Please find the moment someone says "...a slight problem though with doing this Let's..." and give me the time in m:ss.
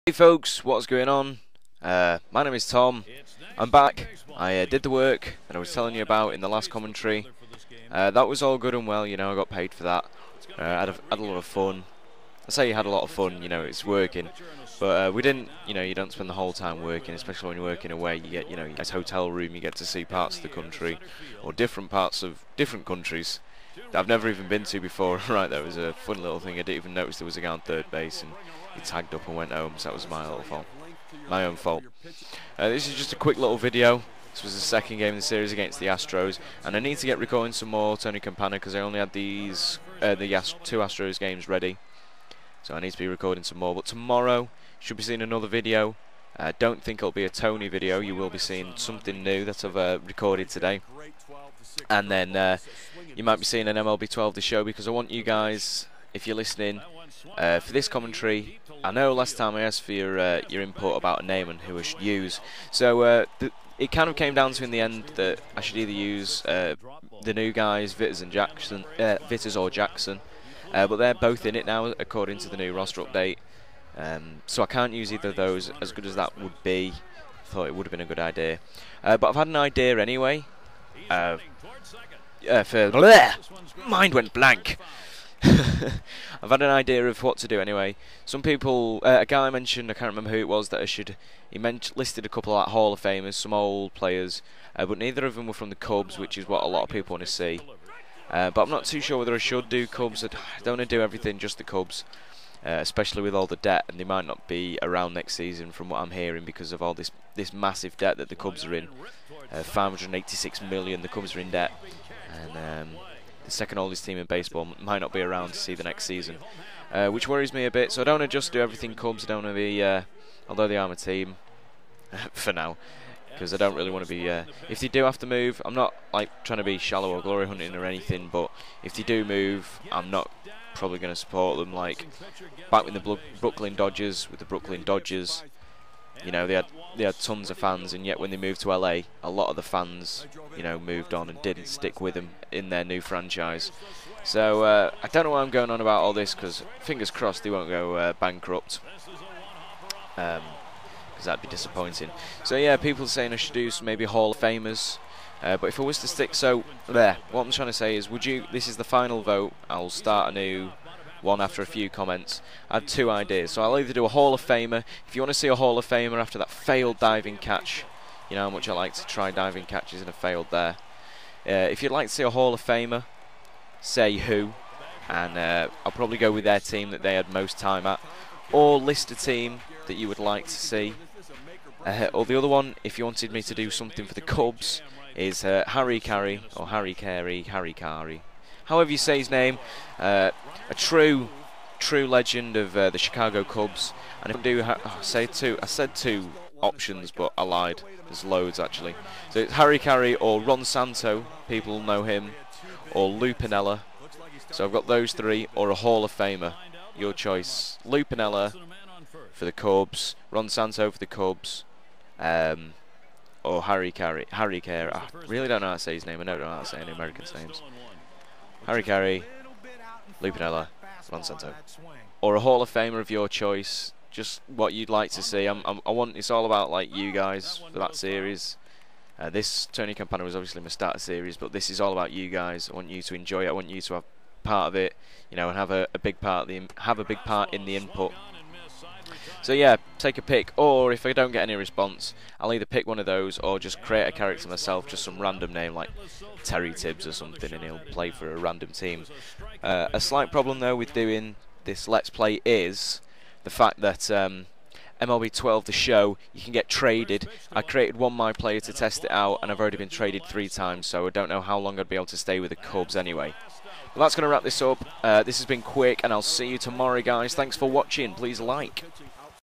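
4:09.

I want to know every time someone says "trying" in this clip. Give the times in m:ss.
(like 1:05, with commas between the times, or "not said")
2:06, 2:37.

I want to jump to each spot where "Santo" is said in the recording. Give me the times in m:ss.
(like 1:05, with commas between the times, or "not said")
3:20, 3:30, 3:41.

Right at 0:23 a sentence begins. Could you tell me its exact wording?
I've never even been to before.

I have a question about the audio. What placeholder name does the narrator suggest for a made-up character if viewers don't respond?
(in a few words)
Terry Tibbs.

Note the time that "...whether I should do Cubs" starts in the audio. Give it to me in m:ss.
1:39.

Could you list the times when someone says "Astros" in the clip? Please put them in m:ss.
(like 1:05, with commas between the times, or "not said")
0:35, 0:40.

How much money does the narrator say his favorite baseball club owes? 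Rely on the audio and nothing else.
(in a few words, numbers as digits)
586 million.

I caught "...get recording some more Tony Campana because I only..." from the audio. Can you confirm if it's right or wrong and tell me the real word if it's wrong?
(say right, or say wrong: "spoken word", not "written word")
right.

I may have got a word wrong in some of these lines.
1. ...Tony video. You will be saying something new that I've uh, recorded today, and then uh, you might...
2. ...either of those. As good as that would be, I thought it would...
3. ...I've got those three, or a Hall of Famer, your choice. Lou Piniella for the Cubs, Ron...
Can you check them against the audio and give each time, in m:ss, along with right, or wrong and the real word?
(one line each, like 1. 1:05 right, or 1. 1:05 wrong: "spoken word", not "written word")
1. 0:47 wrong: "seeing", not "saying"
2. 1:15 right
3. 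3:24 right.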